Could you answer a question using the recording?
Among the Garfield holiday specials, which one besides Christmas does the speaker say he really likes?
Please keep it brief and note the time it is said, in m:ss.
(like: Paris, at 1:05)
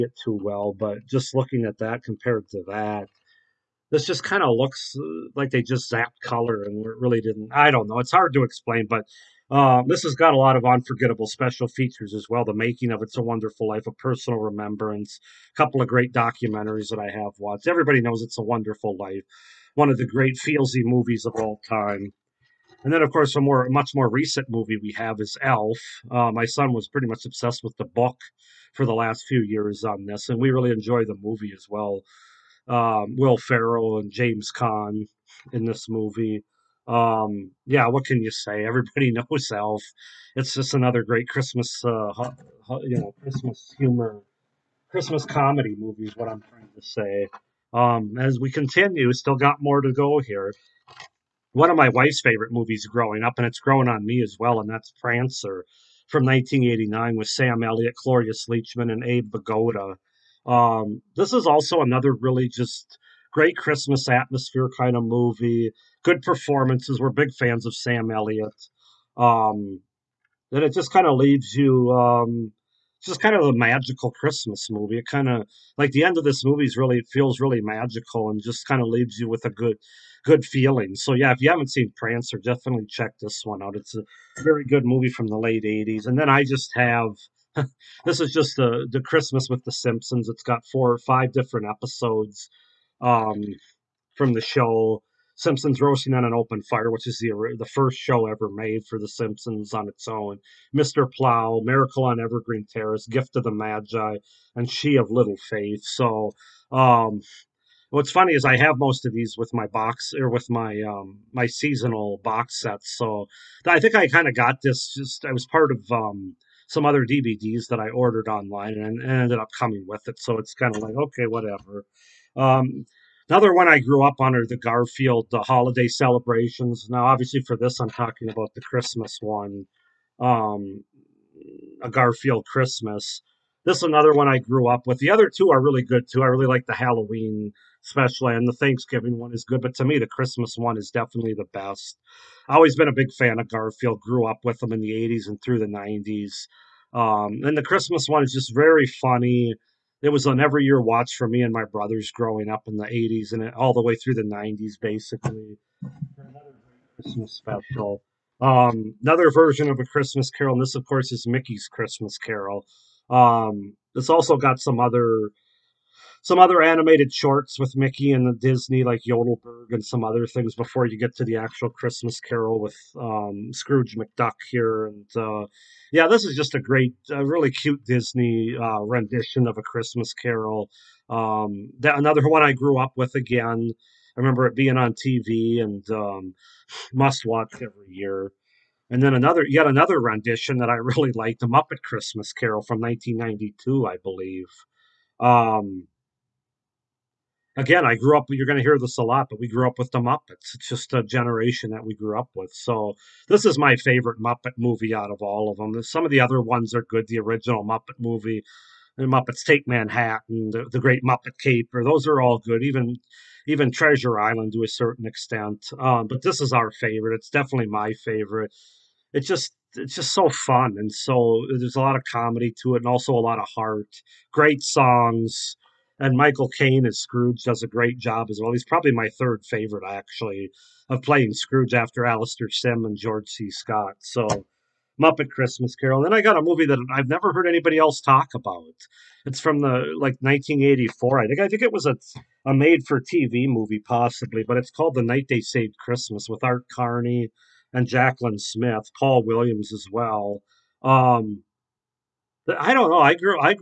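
Halloween special, at 2:16.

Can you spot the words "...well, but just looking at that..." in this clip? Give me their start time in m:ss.
0:00.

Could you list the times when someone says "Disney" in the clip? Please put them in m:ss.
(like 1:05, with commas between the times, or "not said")
2:48, 2:57.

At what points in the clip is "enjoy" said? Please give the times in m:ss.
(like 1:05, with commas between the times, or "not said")
0:30.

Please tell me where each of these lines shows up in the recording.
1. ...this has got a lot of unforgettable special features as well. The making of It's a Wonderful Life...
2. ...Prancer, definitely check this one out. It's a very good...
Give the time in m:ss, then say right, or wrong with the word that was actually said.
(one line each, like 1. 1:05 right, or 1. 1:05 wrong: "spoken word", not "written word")
1. 0:09 right
2. 1:21 right.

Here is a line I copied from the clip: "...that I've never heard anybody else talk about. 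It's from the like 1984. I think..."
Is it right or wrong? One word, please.
right.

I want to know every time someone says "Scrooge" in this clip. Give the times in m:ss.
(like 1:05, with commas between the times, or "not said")
2:53, 3:46, 3:51.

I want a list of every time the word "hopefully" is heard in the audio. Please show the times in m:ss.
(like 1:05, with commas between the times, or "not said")
not said.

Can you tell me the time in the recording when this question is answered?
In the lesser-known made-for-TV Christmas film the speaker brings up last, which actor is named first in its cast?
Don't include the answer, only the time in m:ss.
4:06.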